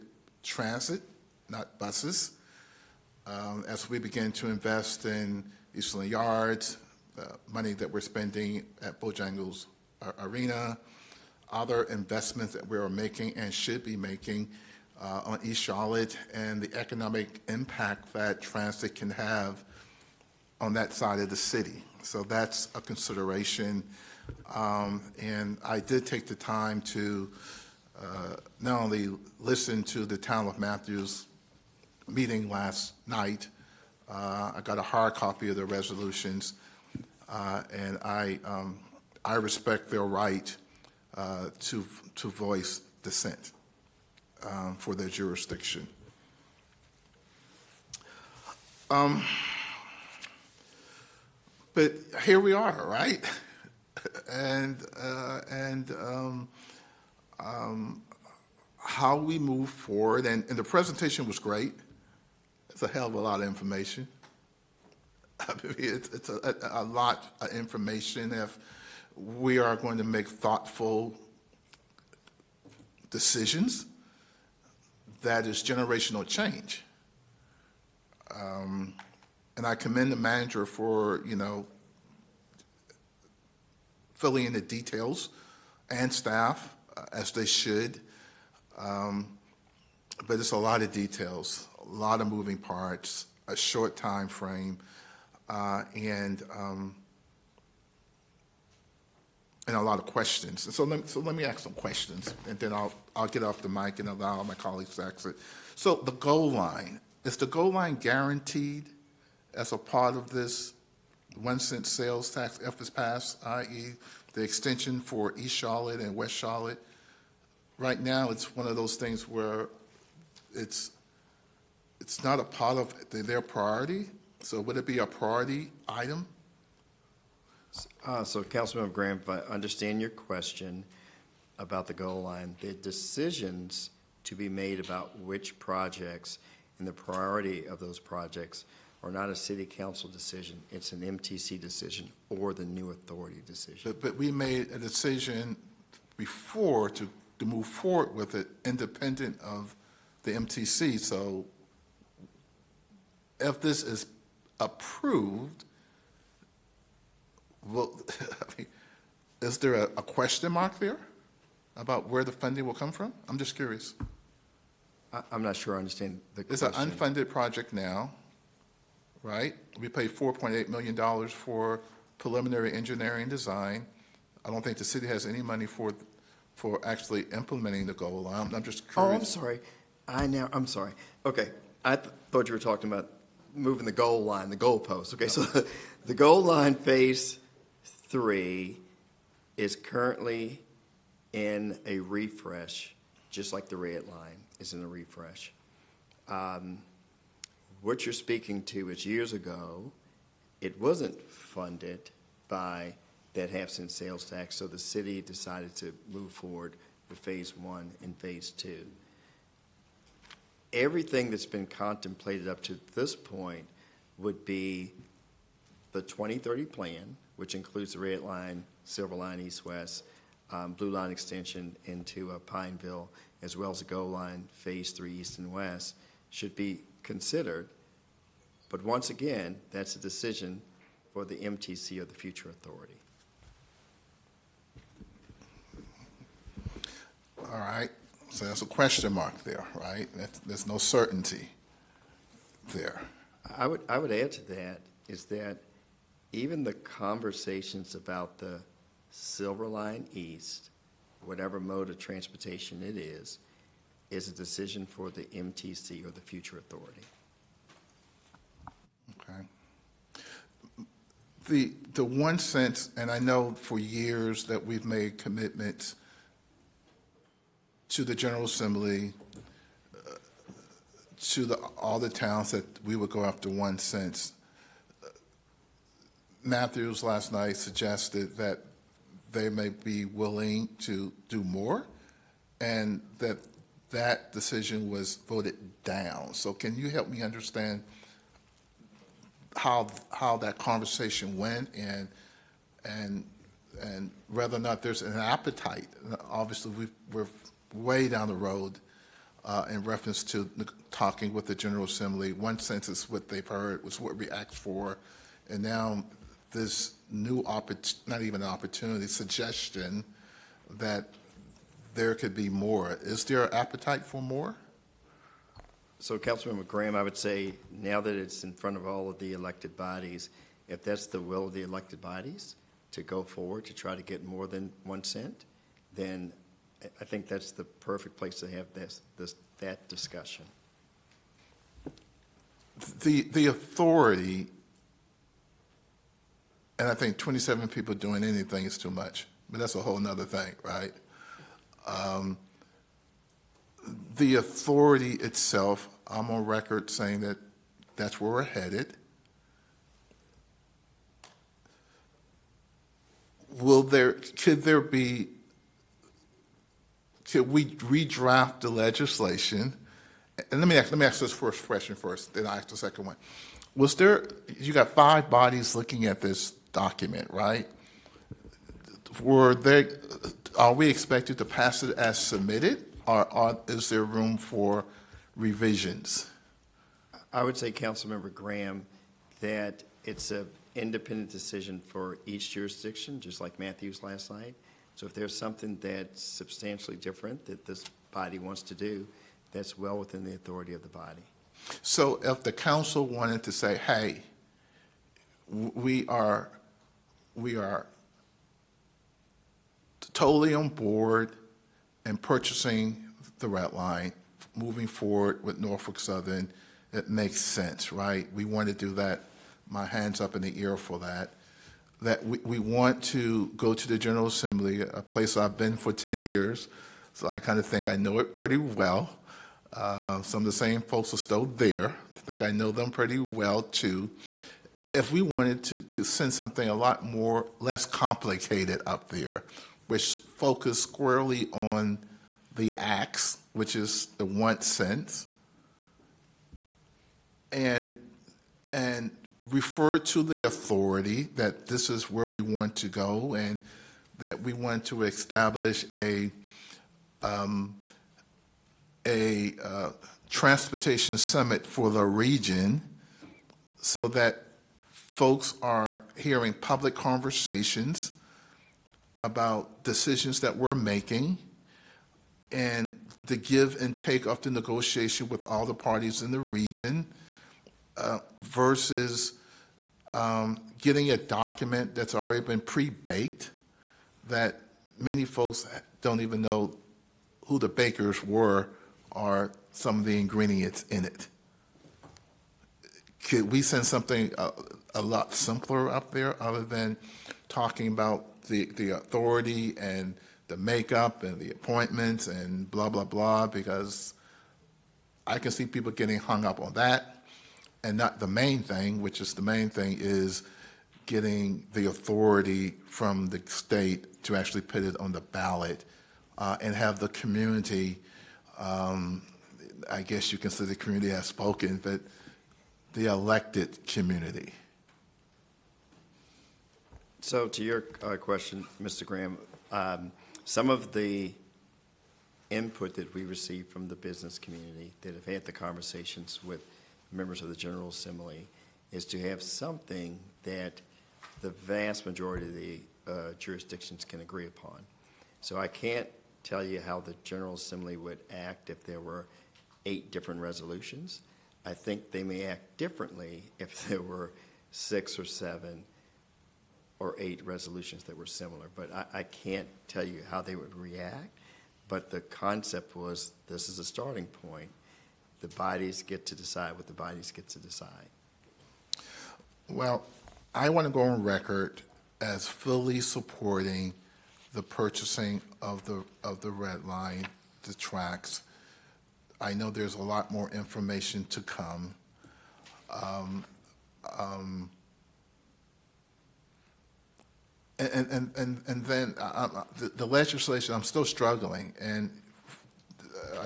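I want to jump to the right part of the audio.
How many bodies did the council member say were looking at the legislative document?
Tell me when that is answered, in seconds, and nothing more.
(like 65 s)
364 s.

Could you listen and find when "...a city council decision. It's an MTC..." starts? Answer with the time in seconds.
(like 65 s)
139 s.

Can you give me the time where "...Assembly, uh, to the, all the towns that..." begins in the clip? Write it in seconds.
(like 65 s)
268 s.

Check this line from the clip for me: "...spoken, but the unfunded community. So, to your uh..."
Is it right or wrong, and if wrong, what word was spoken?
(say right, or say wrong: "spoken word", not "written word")
wrong: "elected", not "unfunded".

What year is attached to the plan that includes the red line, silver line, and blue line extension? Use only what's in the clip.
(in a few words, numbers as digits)
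2030.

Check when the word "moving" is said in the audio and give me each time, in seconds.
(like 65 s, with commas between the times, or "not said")
92 s, 183 s, 404 s.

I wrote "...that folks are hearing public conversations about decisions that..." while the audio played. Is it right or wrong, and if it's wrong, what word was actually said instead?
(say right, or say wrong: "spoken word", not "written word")
right.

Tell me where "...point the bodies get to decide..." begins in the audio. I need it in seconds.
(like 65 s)
554 s.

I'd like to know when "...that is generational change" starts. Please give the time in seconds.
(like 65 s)
75 s.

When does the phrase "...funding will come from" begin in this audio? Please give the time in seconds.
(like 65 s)
162 s.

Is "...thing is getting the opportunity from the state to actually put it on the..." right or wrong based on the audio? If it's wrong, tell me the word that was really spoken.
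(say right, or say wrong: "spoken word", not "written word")
wrong: "authority", not "opportunity".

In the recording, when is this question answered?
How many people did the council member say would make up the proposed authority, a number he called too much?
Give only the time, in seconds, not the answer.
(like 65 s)
337 s.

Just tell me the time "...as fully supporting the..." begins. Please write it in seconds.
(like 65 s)
562 s.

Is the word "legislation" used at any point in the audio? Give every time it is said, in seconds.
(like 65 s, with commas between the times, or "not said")
358 s, 580 s.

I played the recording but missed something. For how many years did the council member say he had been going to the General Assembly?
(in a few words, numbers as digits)
10.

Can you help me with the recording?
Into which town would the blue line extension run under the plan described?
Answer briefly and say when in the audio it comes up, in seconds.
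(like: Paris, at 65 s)
Pineville, at 222 s.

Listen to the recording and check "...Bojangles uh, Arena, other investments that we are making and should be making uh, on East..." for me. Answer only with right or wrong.
right.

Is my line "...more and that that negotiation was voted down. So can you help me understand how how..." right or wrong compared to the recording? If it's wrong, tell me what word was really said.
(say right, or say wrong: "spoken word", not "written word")
wrong: "decision", not "negotiation".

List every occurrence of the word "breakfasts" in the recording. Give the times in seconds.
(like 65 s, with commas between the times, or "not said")
not said.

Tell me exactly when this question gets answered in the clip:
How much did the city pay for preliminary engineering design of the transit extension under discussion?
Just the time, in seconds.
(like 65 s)
170 s.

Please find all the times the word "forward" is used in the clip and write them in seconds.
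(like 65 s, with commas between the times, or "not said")
59 s, 147 s, 206 s, 323 s, 404 s.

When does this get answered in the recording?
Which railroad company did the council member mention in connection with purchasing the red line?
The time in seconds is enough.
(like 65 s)
405 s.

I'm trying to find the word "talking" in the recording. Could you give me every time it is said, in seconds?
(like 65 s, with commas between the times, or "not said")
182 s, 300 s, 487 s.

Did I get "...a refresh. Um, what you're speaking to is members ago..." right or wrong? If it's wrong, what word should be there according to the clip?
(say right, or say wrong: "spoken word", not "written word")
wrong: "years", not "members".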